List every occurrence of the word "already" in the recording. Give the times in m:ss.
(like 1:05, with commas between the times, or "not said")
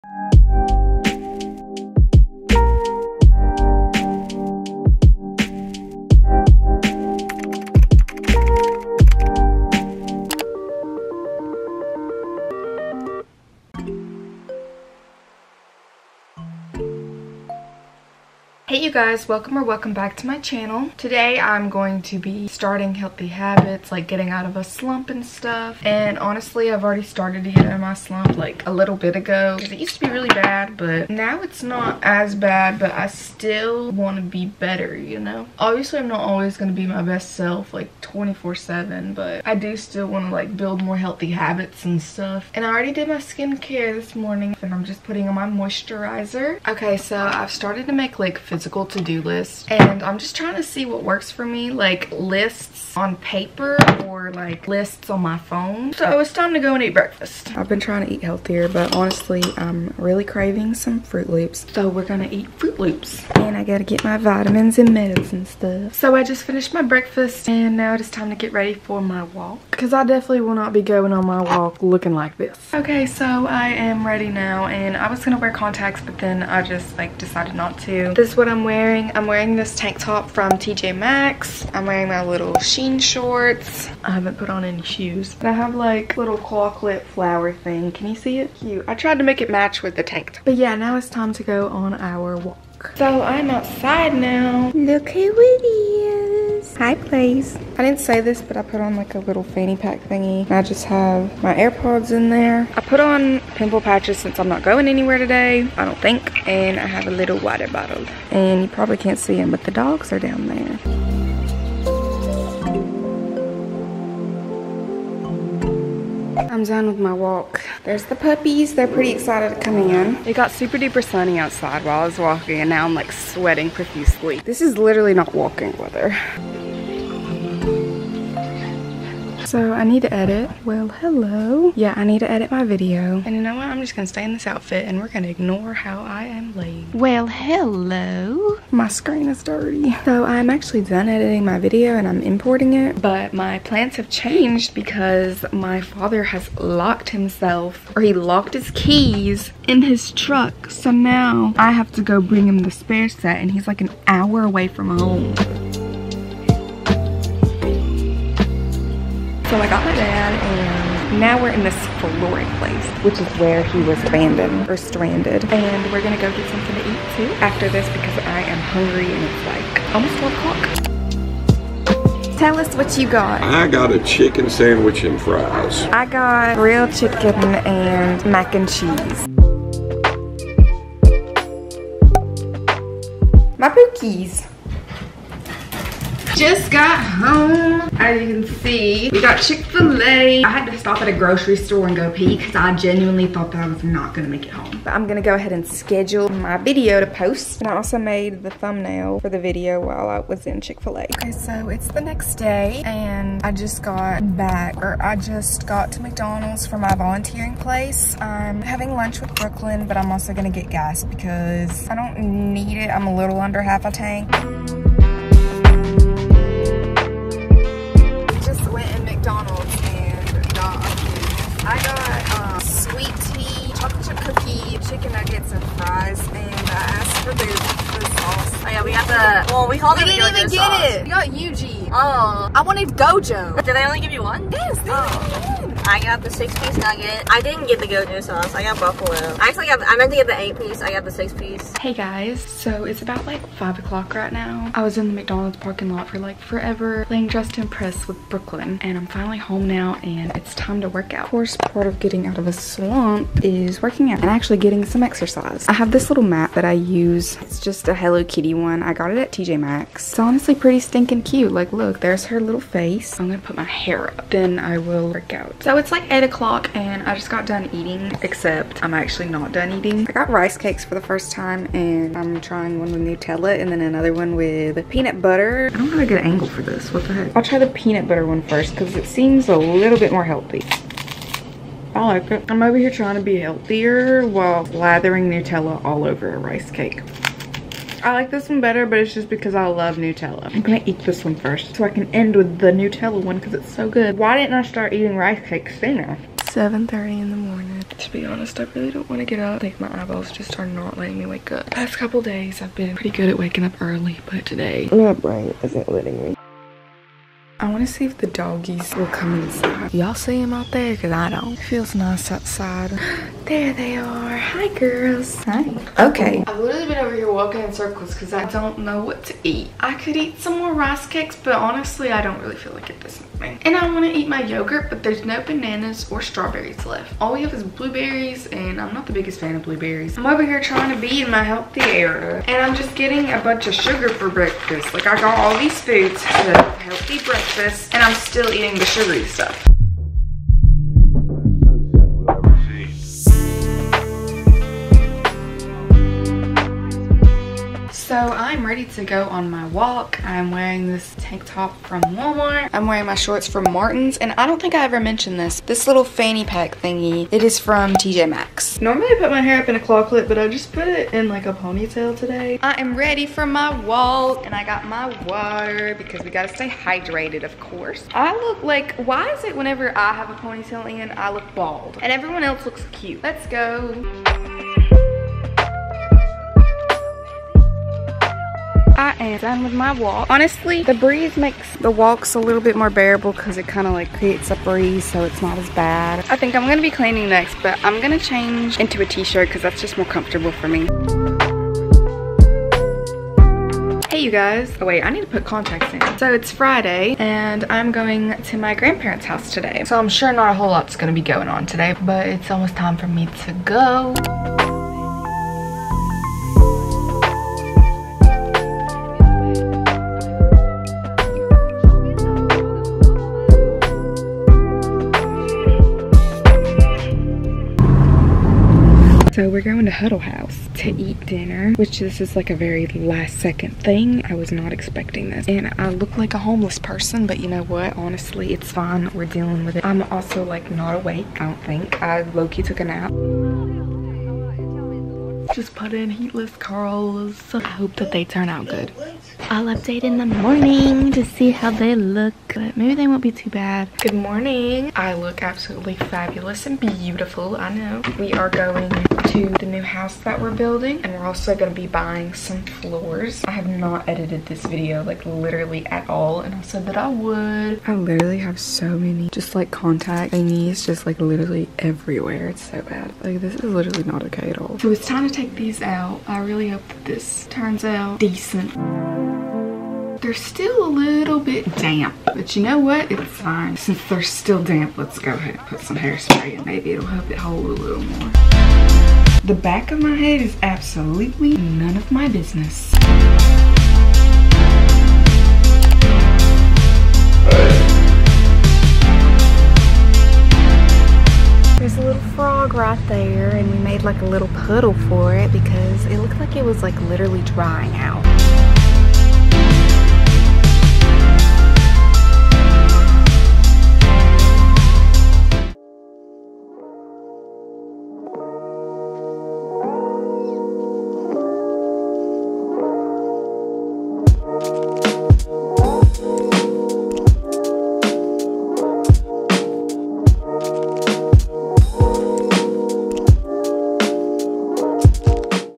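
0:26, 0:42.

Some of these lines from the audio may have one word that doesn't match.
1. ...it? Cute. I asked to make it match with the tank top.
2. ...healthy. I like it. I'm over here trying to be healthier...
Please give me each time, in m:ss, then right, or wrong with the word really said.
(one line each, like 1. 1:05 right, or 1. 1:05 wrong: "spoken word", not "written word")
1. 1:28 wrong: "tried", not "asked"
2. 4:40 right.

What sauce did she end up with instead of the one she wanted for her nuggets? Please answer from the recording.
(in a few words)
Buffalo.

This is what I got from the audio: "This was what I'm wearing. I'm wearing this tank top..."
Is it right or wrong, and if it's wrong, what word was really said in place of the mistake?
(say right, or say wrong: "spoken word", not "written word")
right.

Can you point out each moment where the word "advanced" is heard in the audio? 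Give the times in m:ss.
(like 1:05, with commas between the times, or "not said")
not said.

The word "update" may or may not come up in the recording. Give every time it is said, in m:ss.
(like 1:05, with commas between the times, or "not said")
7:19.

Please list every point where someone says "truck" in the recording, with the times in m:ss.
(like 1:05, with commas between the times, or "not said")
2:30.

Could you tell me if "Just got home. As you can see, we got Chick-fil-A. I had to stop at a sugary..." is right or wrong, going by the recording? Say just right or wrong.
wrong.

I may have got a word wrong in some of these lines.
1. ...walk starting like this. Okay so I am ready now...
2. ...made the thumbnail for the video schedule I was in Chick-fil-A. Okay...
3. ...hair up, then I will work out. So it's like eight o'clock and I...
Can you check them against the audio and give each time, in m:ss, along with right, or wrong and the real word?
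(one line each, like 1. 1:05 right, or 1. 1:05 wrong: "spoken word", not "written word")
1. 1:11 wrong: "looking", not "starting"
2. 3:17 wrong: "while", not "schedule"
3. 4:23 right.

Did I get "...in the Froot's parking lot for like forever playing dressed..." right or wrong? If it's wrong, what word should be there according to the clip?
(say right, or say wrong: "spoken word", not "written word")
wrong: "McDonald", not "Froot".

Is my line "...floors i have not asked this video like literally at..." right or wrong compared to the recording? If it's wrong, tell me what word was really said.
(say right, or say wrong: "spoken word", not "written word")
wrong: "edited", not "asked".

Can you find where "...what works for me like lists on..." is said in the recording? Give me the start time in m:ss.
0:50.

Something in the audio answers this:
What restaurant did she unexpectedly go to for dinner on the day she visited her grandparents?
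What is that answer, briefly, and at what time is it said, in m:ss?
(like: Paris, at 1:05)
Huddle House, at 7:00.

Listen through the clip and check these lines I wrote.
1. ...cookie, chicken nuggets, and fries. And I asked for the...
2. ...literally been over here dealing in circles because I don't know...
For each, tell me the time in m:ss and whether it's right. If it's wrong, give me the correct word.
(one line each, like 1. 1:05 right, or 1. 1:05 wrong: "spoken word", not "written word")
1. 3:44 right
2. 5:16 wrong: "walking", not "dealing".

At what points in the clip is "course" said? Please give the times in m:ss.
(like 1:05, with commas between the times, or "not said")
4:11, 6:07.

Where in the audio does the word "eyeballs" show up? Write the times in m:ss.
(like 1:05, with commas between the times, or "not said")
5:00.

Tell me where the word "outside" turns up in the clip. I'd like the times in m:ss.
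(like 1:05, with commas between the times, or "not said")
1:33, 2:01, 5:12.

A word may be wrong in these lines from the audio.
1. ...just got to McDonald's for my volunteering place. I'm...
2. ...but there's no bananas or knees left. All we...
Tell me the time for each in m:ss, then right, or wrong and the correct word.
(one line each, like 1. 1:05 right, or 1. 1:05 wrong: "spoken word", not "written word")
1. 3:25 right
2. 5:24 wrong: "strawberries", not "knees".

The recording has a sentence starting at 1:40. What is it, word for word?
I just have my AirPods in there.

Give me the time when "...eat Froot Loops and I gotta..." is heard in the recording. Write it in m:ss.
1:02.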